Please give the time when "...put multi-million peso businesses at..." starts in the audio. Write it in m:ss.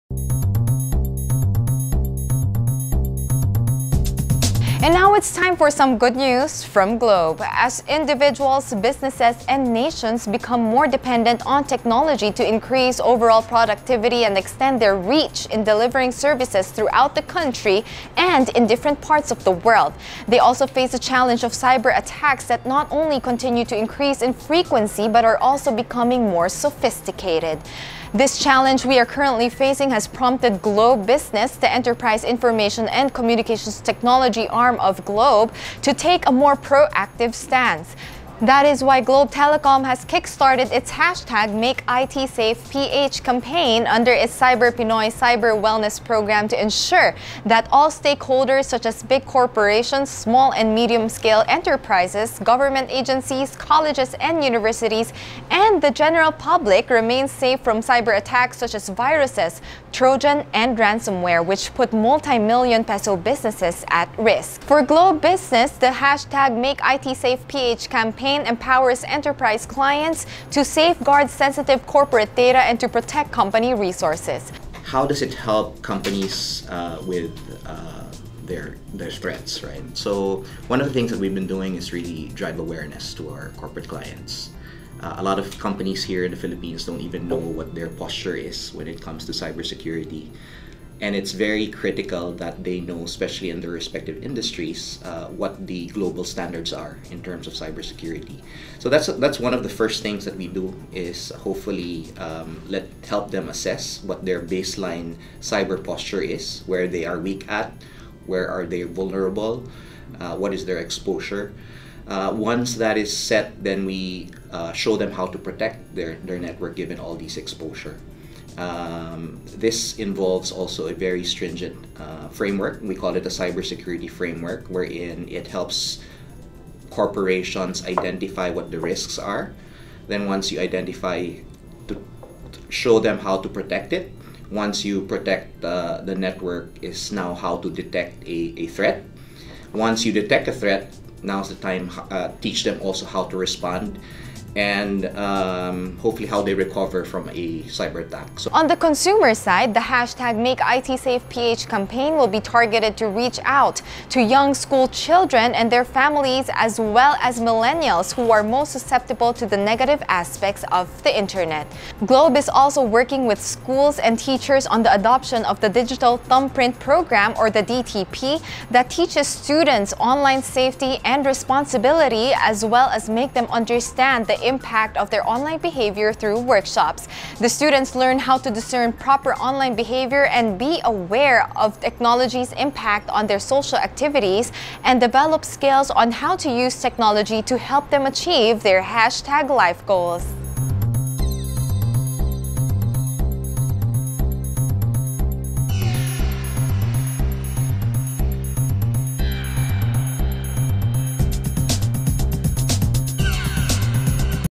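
1:01.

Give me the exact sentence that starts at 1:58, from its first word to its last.
Um, this involves also a very stringent uh, framework.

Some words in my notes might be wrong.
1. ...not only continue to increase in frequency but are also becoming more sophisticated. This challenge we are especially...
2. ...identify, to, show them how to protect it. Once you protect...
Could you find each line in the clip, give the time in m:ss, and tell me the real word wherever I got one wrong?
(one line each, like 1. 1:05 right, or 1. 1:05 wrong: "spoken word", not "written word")
1. 0:22 wrong: "currently", not "especially"
2. 2:10 right.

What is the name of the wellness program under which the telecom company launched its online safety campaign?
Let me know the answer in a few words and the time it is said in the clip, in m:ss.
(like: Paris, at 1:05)
Cyber Pinoy Cyber Wellness Program, at 0:44.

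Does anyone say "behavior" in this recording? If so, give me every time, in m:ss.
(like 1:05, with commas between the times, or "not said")
2:55, 2:59.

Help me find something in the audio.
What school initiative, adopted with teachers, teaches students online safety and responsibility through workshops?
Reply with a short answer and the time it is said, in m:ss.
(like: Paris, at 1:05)
Digital Thumbprint Program, at 2:45.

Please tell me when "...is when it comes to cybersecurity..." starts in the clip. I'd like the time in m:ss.
1:28.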